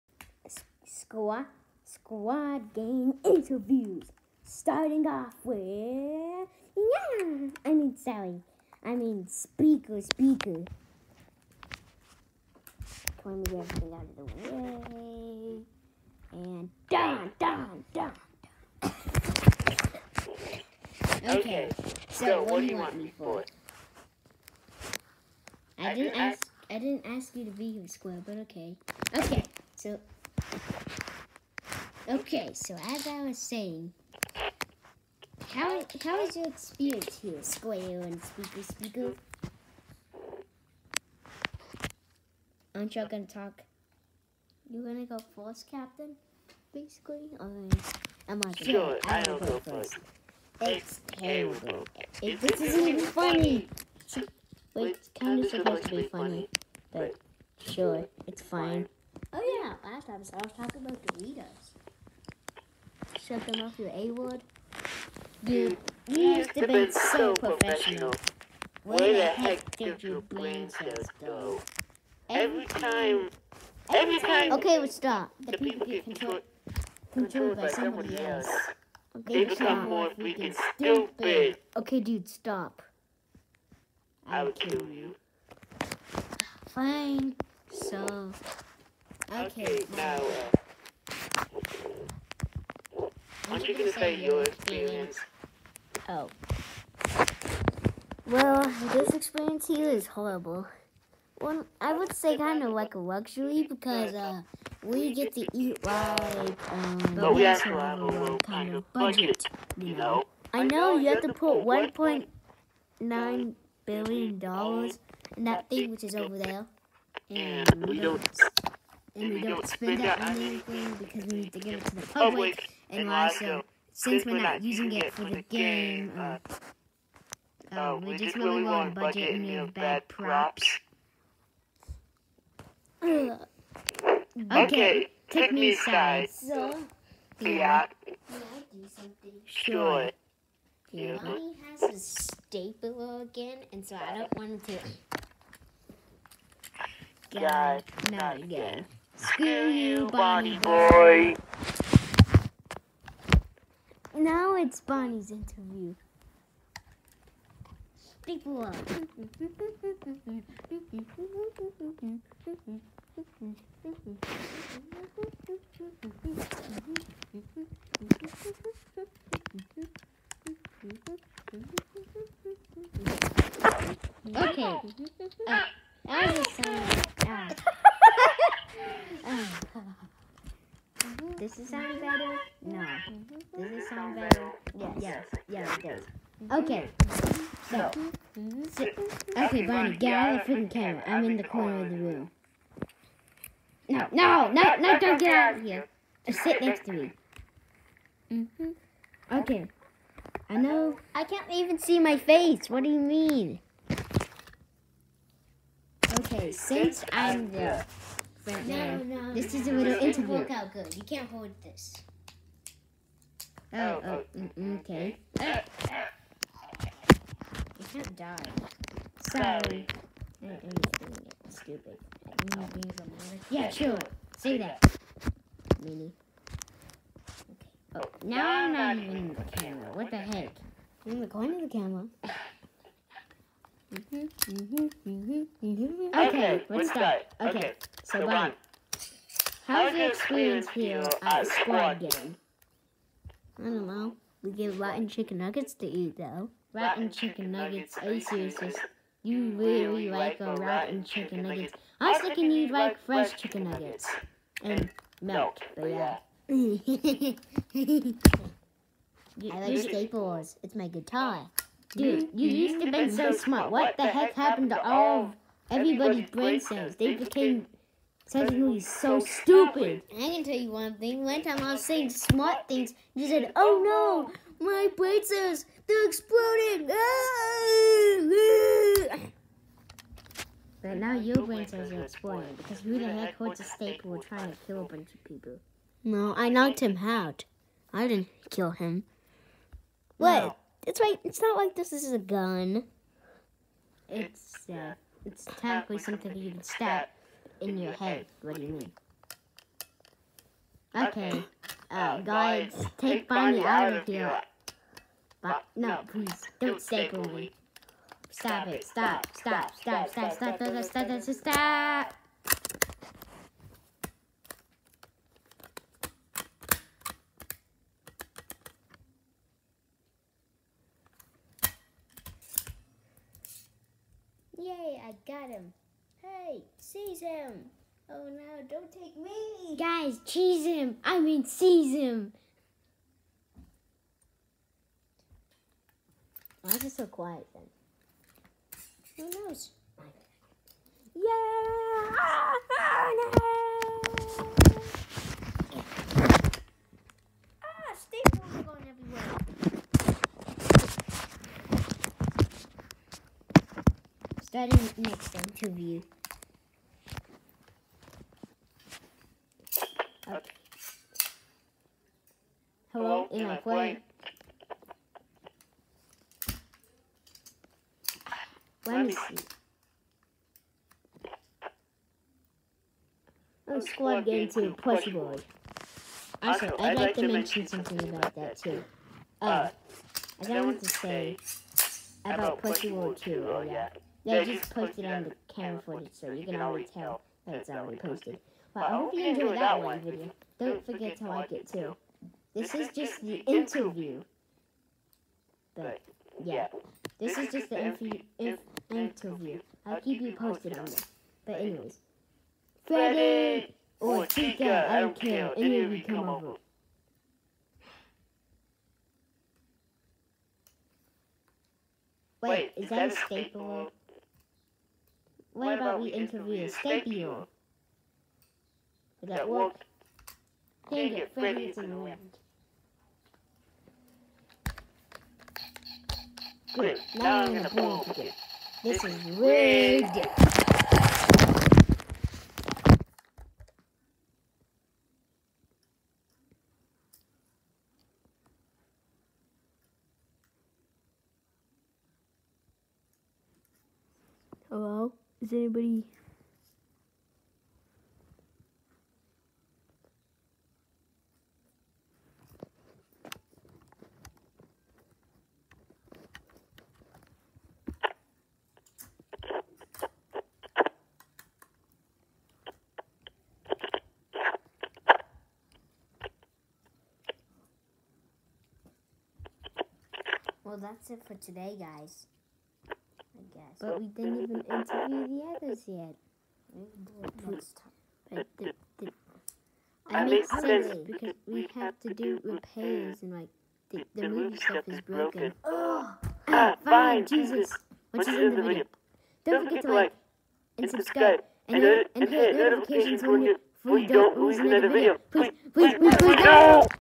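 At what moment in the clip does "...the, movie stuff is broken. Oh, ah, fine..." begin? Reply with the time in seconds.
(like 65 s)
484 s.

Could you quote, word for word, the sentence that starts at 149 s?
Screw you, Bonnie boy now it's Bonnie's interview.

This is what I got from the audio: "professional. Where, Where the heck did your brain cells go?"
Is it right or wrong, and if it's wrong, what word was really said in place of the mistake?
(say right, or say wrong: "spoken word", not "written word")
right.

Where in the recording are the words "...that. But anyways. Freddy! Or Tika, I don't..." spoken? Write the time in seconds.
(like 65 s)
400 s.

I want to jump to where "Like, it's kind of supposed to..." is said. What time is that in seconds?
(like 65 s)
54 s.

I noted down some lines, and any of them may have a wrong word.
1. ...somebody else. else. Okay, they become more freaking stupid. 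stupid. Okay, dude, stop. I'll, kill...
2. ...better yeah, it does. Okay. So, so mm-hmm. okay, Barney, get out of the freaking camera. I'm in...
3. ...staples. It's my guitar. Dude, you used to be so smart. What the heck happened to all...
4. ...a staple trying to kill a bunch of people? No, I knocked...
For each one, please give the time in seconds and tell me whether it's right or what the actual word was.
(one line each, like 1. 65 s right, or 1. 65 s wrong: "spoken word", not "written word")
1. 77 s right
2. 181 s right
3. 259 s right
4. 283 s right.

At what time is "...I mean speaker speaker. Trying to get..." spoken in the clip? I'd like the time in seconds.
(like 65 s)
8 s.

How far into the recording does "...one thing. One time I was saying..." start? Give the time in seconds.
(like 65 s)
270 s.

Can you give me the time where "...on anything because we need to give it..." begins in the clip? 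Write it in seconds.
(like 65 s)
120 s.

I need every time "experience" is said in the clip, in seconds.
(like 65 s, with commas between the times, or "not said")
36 s, 94 s, 99 s, 240 s.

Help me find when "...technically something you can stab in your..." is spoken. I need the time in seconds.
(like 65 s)
295 s.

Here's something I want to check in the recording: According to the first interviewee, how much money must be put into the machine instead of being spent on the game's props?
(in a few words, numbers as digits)
1.9 billion dollars.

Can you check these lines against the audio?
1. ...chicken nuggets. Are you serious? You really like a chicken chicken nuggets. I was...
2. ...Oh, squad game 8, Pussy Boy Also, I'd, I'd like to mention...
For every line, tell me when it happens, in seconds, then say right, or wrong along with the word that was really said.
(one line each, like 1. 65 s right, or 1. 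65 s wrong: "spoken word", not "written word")
1. 247 s wrong: "rotten", not "chicken"
2. 373 s wrong: "2", not "8".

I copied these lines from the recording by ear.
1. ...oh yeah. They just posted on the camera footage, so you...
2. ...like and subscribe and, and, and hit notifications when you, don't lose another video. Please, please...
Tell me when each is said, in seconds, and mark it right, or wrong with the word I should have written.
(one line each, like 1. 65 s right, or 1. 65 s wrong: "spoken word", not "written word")
1. 383 s right
2. 489 s right.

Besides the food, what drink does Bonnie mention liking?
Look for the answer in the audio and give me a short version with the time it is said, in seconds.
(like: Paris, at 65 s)
Milk, at 255 s.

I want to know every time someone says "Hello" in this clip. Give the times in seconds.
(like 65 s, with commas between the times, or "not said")
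362 s, 444 s.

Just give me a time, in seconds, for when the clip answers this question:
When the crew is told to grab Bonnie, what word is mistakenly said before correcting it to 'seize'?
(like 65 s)
330 s.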